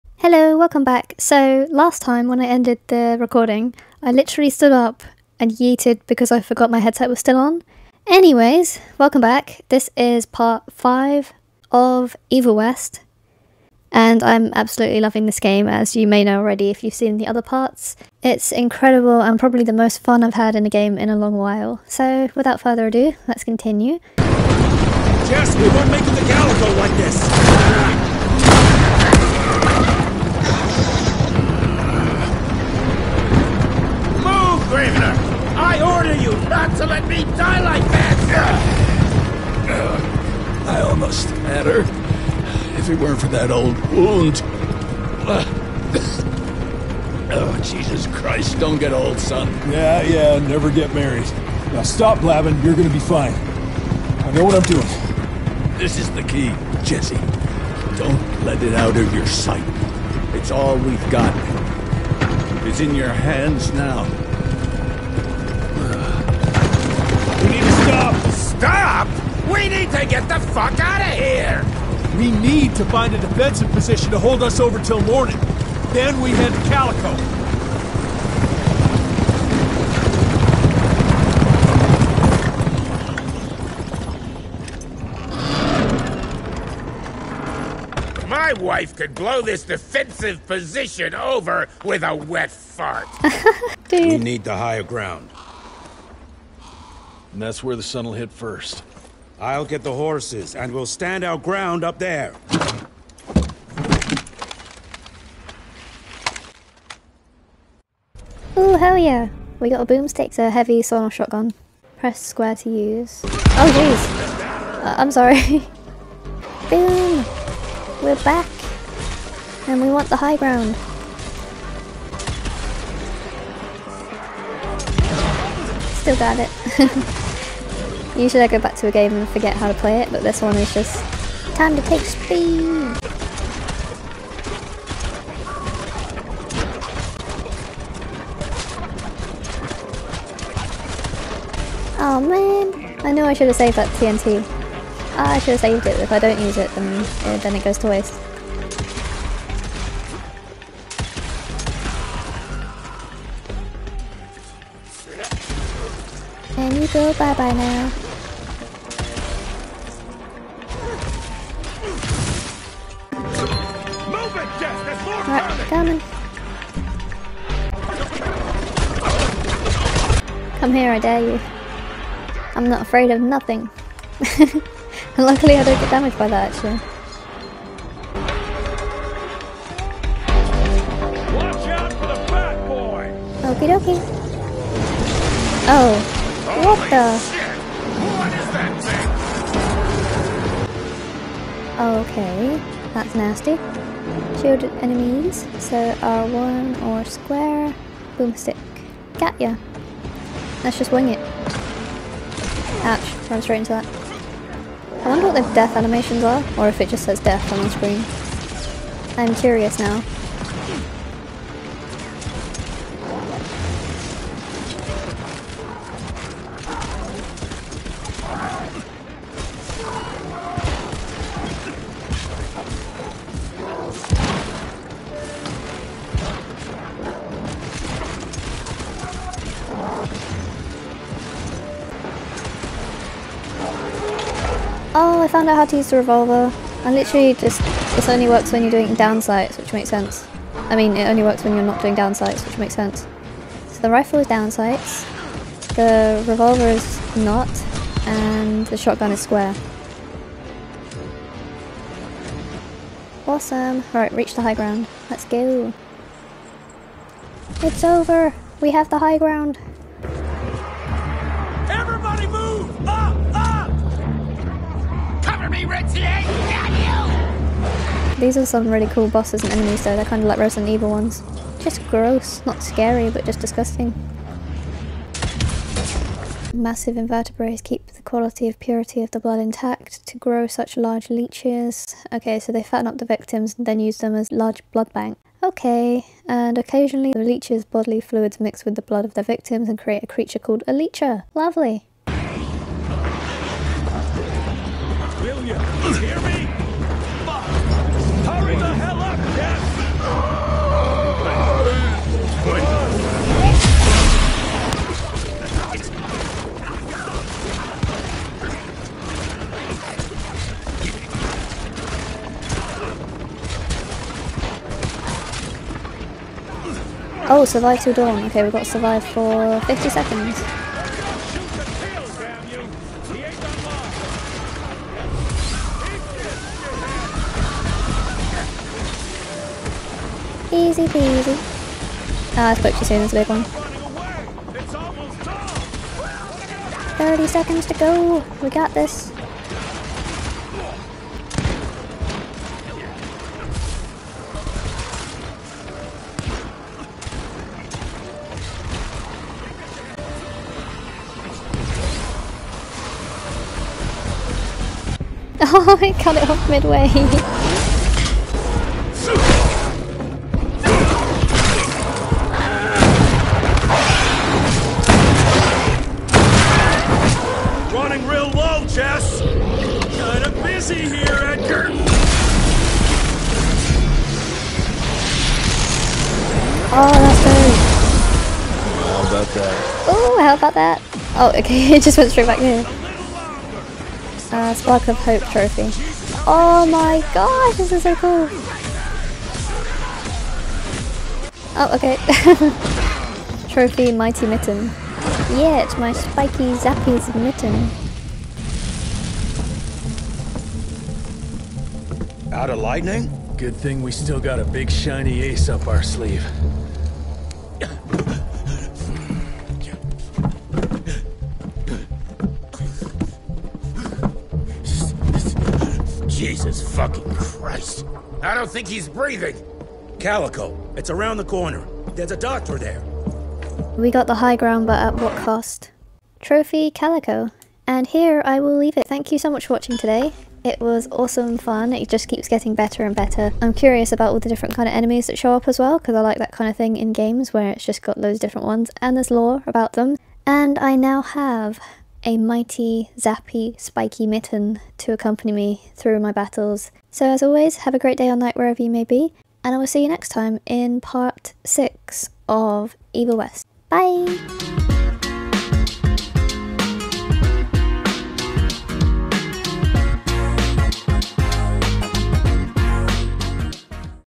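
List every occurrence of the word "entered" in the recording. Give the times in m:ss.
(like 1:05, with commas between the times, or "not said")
not said.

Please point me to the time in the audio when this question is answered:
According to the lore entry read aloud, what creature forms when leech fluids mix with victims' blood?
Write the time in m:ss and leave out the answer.
4:50.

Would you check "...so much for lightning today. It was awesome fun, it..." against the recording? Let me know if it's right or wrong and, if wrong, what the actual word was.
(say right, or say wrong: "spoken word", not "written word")
wrong: "watching", not "lightning".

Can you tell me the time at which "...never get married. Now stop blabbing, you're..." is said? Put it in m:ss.
0:50.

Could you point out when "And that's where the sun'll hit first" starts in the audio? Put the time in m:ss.
1:37.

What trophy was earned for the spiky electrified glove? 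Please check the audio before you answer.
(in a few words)
Mighty Mitten.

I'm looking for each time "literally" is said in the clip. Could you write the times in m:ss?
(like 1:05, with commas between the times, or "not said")
0:04, 3:56.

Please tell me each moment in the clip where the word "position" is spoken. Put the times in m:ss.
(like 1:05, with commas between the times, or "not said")
1:13, 1:30.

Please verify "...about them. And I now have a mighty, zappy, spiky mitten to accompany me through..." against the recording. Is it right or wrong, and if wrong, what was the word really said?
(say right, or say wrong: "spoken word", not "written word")
right.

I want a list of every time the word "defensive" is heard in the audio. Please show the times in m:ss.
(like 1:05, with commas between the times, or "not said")
1:13, 1:29.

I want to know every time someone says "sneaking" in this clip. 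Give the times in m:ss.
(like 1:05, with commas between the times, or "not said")
not said.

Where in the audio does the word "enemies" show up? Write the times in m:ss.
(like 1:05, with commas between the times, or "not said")
3:14, 4:29, 7:14.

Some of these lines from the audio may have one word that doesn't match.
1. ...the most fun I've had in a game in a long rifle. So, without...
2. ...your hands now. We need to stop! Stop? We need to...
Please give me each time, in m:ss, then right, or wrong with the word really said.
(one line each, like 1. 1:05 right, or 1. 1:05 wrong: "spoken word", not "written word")
1. 0:19 wrong: "while", not "rifle"
2. 1:02 right.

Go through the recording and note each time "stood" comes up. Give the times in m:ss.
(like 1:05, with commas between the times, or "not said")
0:04.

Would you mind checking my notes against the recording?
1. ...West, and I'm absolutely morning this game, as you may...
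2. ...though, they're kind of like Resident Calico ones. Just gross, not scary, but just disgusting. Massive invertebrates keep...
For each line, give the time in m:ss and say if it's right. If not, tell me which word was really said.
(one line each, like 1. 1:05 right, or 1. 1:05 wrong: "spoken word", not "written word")
1. 0:12 wrong: "loving", not "morning"
2. 4:29 wrong: "Evil", not "Calico".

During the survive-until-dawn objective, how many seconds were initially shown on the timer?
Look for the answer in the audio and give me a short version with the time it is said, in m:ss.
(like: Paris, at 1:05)
50, at 5:19.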